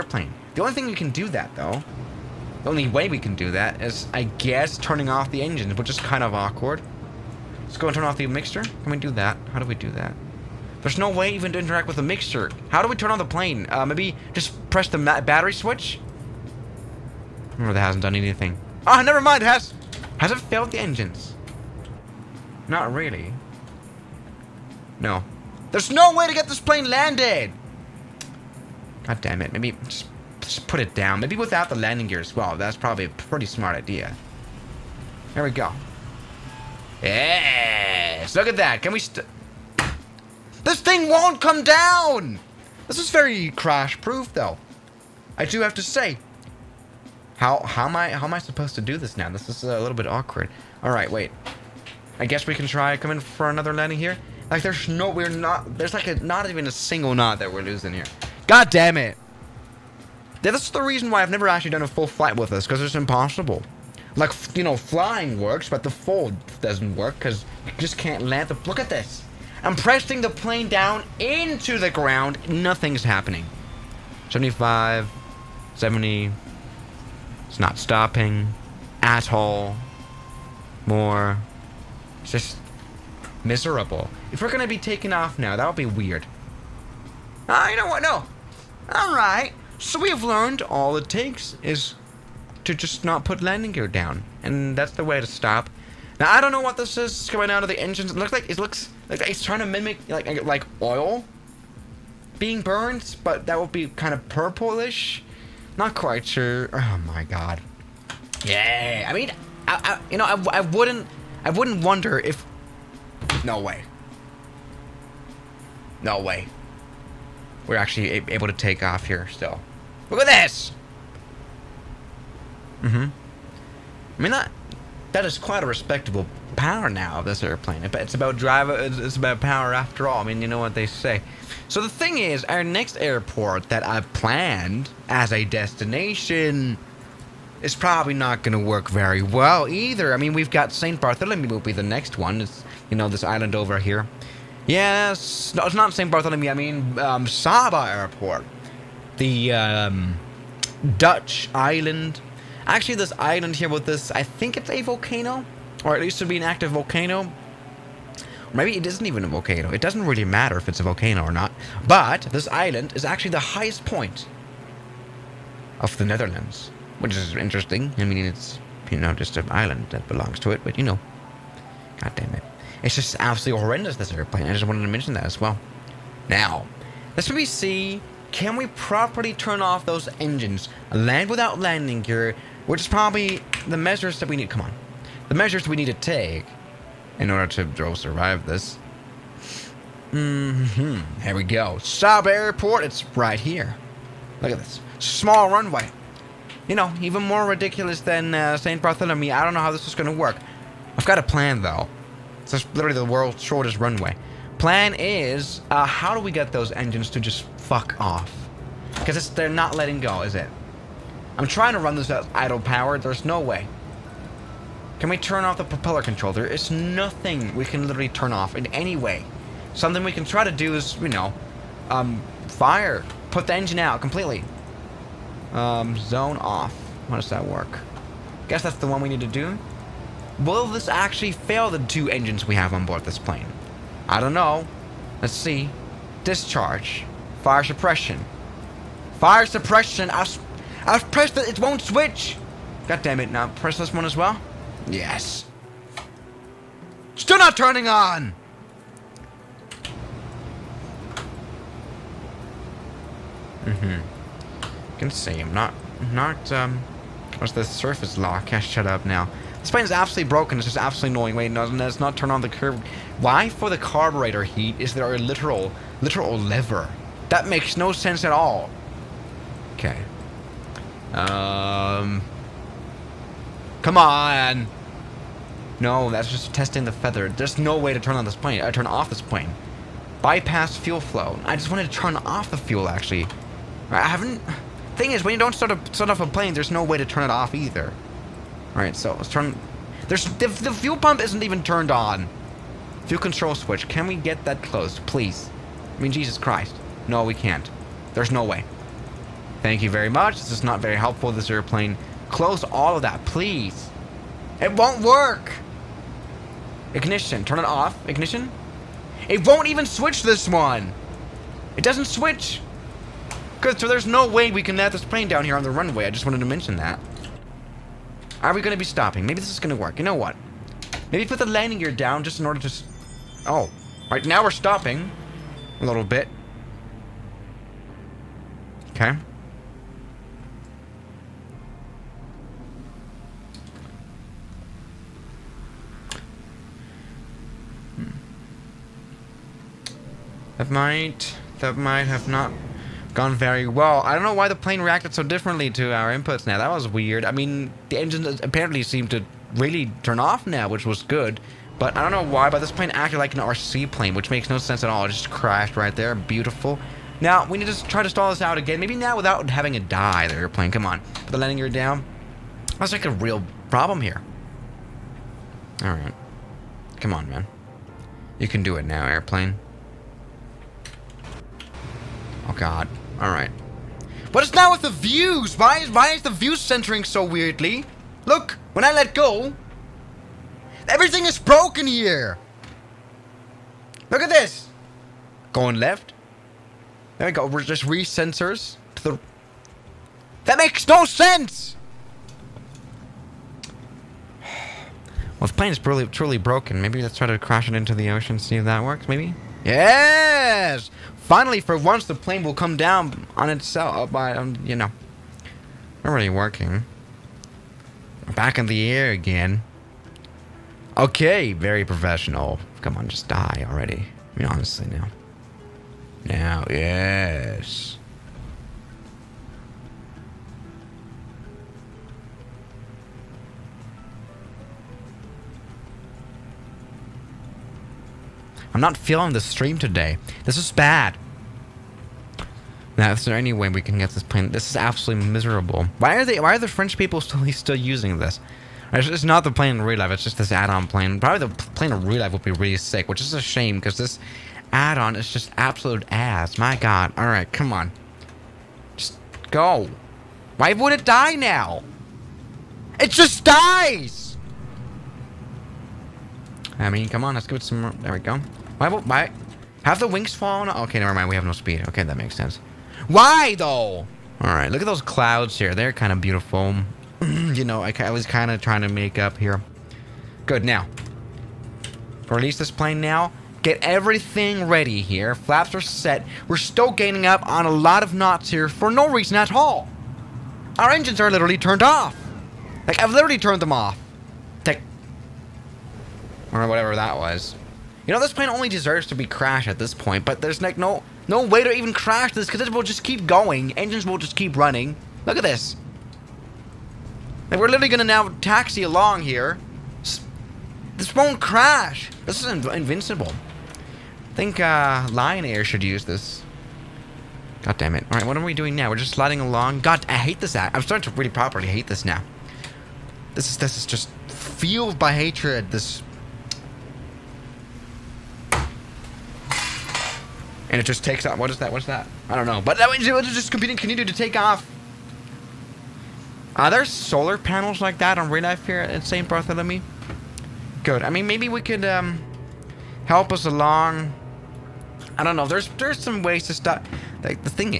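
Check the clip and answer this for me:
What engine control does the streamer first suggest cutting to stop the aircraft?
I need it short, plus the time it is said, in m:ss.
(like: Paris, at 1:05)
The mixture, at 0:08.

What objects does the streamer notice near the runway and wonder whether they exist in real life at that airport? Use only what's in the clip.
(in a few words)
Solar panels.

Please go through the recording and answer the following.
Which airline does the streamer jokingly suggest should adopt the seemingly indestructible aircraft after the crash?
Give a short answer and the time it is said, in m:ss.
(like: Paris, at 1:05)
Lion Air, at 8:25.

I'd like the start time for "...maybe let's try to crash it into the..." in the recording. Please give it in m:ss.
6:36.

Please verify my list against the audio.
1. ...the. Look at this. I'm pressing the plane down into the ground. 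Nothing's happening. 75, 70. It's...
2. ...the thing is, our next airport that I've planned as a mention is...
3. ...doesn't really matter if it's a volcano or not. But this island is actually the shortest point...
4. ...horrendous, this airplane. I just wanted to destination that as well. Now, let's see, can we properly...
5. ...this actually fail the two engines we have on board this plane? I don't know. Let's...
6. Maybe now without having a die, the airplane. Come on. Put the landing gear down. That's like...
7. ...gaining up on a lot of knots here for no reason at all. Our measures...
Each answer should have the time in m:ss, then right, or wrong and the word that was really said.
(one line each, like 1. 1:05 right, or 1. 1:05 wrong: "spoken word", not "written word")
1. 1:08 right
2. 2:11 wrong: "destination", not "mention"
3. 2:39 wrong: "highest", not "shortest"
4. 2:53 wrong: "mention", not "destination"
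5. 3:50 right
6. 5:58 right
7. 7:56 wrong: "engines", not "measures".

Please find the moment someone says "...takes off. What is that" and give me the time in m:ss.
8:41.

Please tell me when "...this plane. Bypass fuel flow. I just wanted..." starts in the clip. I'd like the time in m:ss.
4:39.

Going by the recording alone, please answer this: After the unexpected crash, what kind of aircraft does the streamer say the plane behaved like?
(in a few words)
An RC plane.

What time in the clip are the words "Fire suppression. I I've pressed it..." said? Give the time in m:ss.
3:59.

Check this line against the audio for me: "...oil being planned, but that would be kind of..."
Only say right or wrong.
wrong.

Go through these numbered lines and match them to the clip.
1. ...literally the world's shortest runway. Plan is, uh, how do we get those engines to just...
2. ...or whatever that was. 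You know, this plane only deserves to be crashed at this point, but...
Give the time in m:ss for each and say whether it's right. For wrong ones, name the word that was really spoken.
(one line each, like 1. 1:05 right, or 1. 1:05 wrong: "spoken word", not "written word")
1. 3:22 right
2. 8:06 right.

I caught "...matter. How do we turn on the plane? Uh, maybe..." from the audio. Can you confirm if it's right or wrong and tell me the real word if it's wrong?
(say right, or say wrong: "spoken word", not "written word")
wrong: "mixer", not "matter".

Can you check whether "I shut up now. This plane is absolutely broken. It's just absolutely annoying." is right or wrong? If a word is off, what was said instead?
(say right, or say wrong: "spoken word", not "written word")
right.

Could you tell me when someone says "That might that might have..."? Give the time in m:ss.
5:40.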